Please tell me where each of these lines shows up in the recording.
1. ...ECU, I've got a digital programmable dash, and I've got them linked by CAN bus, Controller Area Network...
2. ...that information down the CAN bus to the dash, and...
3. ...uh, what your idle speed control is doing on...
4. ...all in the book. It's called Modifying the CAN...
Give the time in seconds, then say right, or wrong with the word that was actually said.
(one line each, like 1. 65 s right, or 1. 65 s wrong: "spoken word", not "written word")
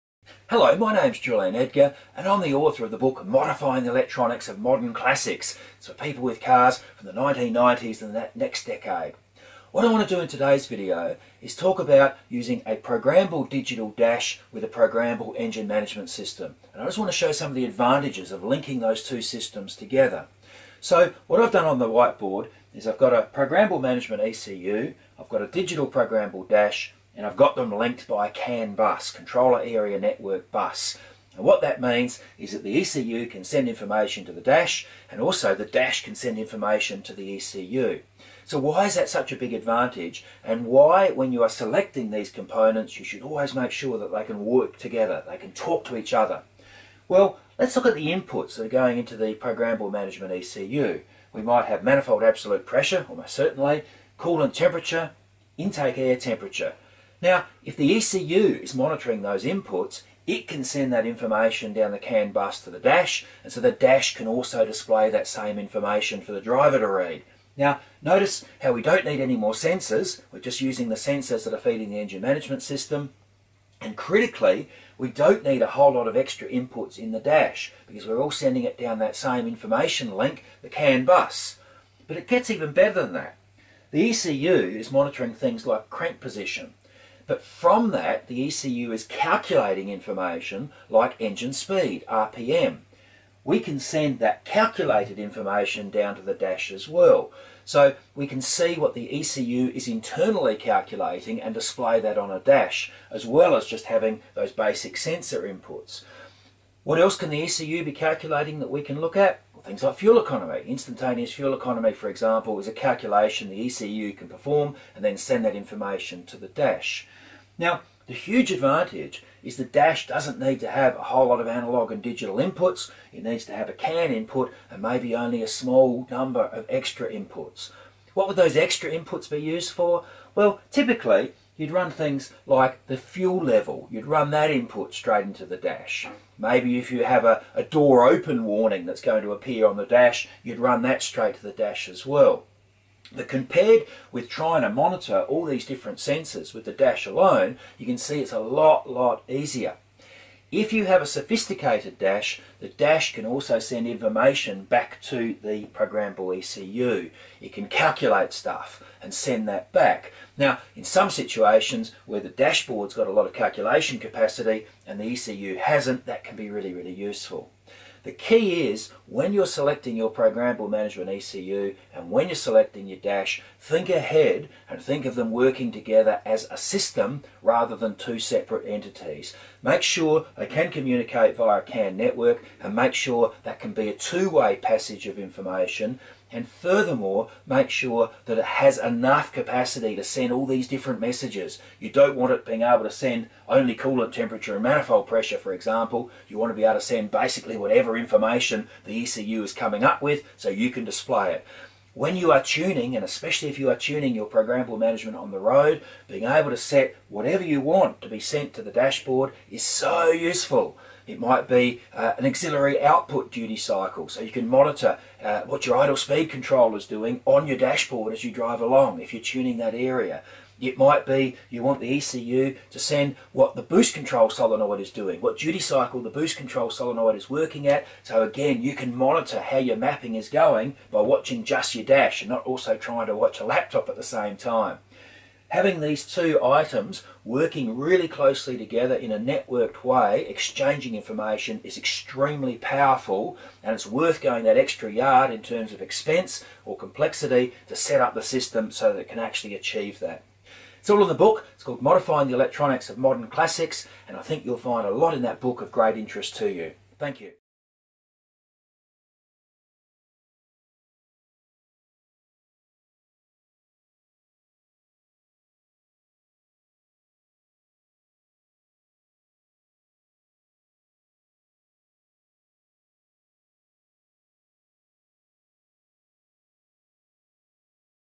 1. 24 s right
2. 60 s right
3. 215 s right
4. 250 s wrong: "Electronics", not "CAN".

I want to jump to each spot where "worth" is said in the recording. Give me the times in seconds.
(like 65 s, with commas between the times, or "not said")
243 s.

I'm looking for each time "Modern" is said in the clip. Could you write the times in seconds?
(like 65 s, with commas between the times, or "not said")
4 s, 252 s.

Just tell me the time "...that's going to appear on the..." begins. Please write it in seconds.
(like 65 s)
138 s.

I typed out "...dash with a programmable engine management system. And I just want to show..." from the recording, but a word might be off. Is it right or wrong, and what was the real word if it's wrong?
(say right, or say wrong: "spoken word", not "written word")
right.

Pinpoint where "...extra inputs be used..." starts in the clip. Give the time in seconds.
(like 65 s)
128 s.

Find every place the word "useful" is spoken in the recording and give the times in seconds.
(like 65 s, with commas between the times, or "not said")
166 s, 210 s.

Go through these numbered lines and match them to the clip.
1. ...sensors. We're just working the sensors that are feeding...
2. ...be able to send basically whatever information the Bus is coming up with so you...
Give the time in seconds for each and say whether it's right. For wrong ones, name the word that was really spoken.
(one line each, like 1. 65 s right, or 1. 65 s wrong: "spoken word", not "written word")
1. 69 s wrong: "using", not "working"
2. 196 s wrong: "ECU", not "Bus".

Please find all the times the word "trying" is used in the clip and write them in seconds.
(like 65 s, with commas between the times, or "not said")
144 s, 232 s.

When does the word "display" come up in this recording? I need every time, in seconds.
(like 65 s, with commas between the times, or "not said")
64 s, 101 s, 200 s.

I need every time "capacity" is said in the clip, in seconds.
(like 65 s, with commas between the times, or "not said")
163 s, 189 s.